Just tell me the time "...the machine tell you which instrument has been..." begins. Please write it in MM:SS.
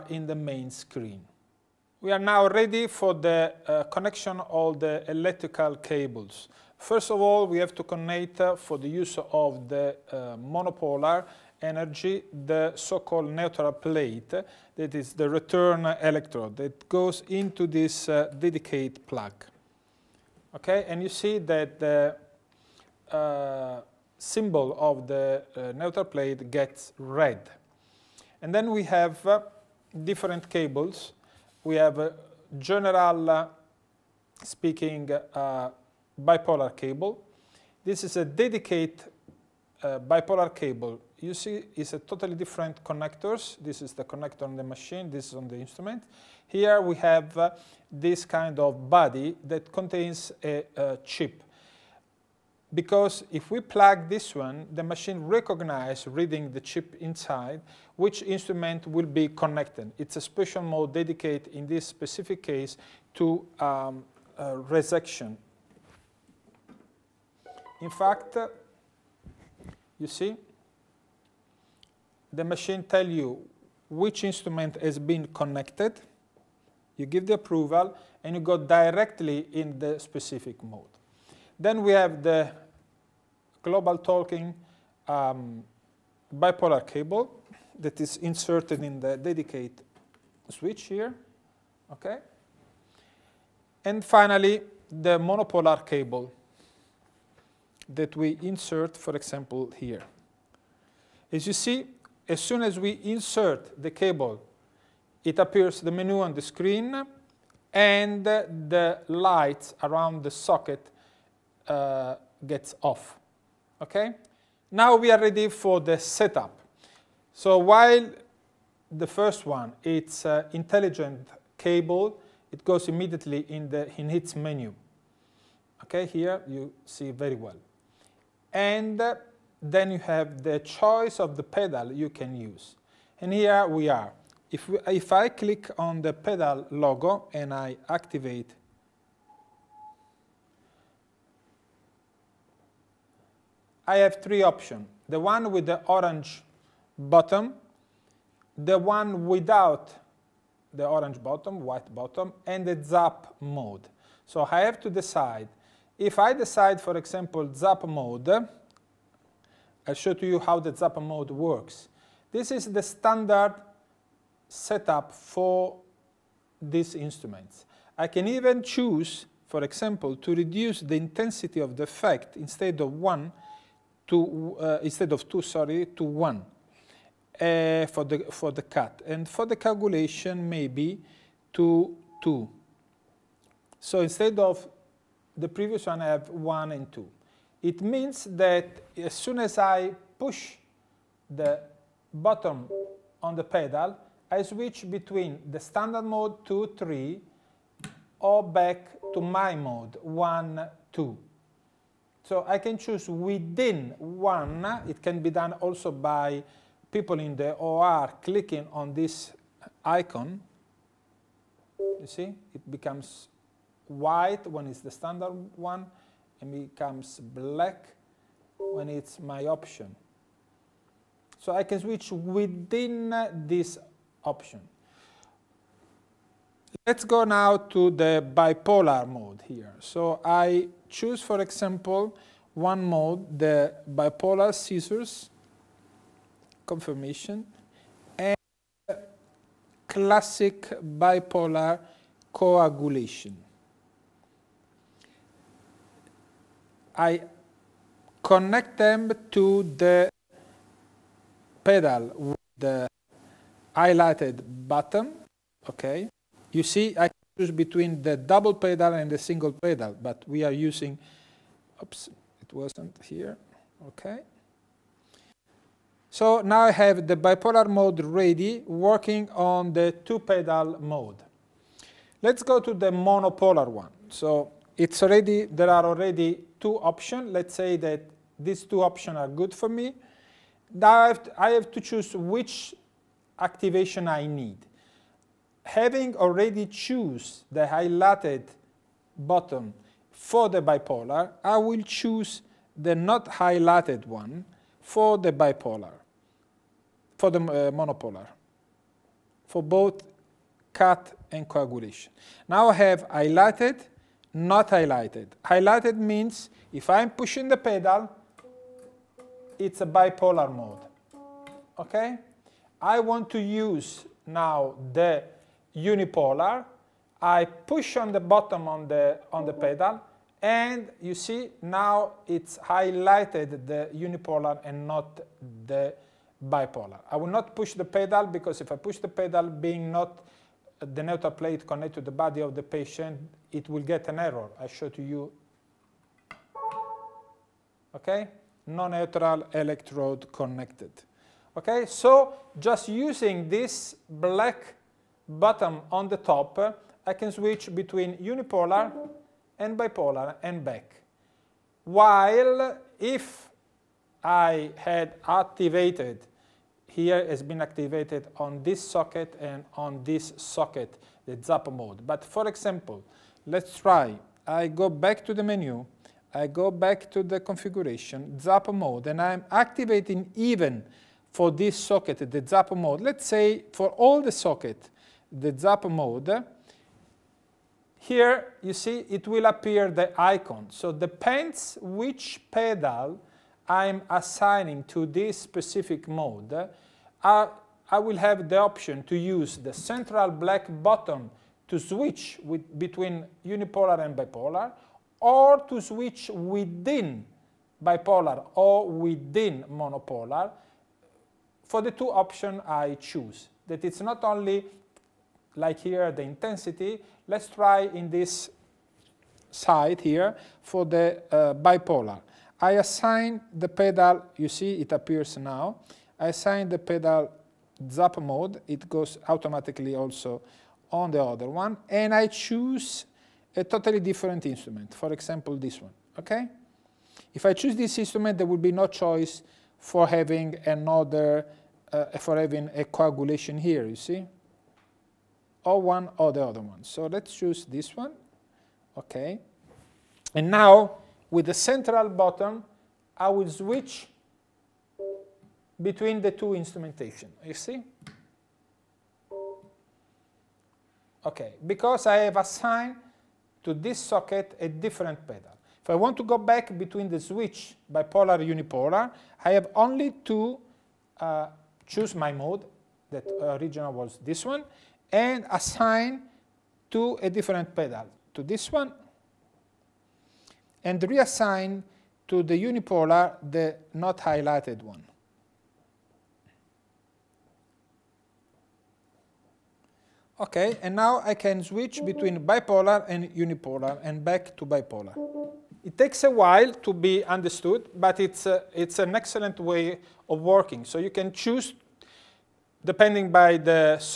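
01:12.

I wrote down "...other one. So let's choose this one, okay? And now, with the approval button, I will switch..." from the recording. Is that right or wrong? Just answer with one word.
wrong.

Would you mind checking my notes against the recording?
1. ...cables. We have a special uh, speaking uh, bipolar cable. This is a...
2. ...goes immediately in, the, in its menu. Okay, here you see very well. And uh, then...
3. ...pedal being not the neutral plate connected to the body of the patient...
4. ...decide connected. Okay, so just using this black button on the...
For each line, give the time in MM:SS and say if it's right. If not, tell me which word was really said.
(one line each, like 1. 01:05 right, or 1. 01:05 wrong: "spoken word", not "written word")
1. 00:30 wrong: "general", not "special"
2. 02:02 right
3. 05:29 right
4. 05:39 wrong: "electrode", not "decide".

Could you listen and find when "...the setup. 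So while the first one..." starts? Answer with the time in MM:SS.
01:55.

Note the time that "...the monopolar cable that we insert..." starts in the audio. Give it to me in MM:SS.
01:34.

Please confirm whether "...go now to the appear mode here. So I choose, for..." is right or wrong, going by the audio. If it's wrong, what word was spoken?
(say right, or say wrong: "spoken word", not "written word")
wrong: "bipolar", not "appear".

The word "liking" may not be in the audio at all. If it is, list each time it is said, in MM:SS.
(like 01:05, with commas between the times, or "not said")
not said.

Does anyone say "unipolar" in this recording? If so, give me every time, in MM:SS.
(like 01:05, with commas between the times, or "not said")
05:15, 05:23, 05:48, 06:33, 07:38, 07:52, 08:03.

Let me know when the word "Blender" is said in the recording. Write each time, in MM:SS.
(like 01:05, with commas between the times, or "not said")
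not said.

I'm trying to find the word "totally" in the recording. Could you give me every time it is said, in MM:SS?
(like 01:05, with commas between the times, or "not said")
00:41, 07:03.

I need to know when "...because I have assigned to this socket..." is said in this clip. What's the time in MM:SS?
07:31.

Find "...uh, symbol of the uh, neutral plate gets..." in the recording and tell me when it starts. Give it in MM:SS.
00:23.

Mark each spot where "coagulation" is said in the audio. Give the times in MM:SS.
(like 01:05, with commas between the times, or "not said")
02:59, 04:02, 05:01, 07:12.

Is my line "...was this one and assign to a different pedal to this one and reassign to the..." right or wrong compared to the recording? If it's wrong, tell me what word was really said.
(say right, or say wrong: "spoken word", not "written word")
right.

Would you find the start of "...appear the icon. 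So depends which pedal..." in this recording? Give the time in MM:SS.
06:19.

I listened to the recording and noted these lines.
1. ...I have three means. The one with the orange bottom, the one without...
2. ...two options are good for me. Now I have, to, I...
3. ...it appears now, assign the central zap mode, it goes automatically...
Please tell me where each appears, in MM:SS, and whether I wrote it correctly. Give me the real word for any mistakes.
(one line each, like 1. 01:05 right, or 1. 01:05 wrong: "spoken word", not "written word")
1. 02:23 wrong: "options", not "means"
2. 04:38 right
3. 06:54 wrong: "pedal", not "central".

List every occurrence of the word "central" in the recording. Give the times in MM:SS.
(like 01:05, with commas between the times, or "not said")
06:29, 07:21.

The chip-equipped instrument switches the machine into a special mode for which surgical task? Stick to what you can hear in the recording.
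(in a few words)
resection.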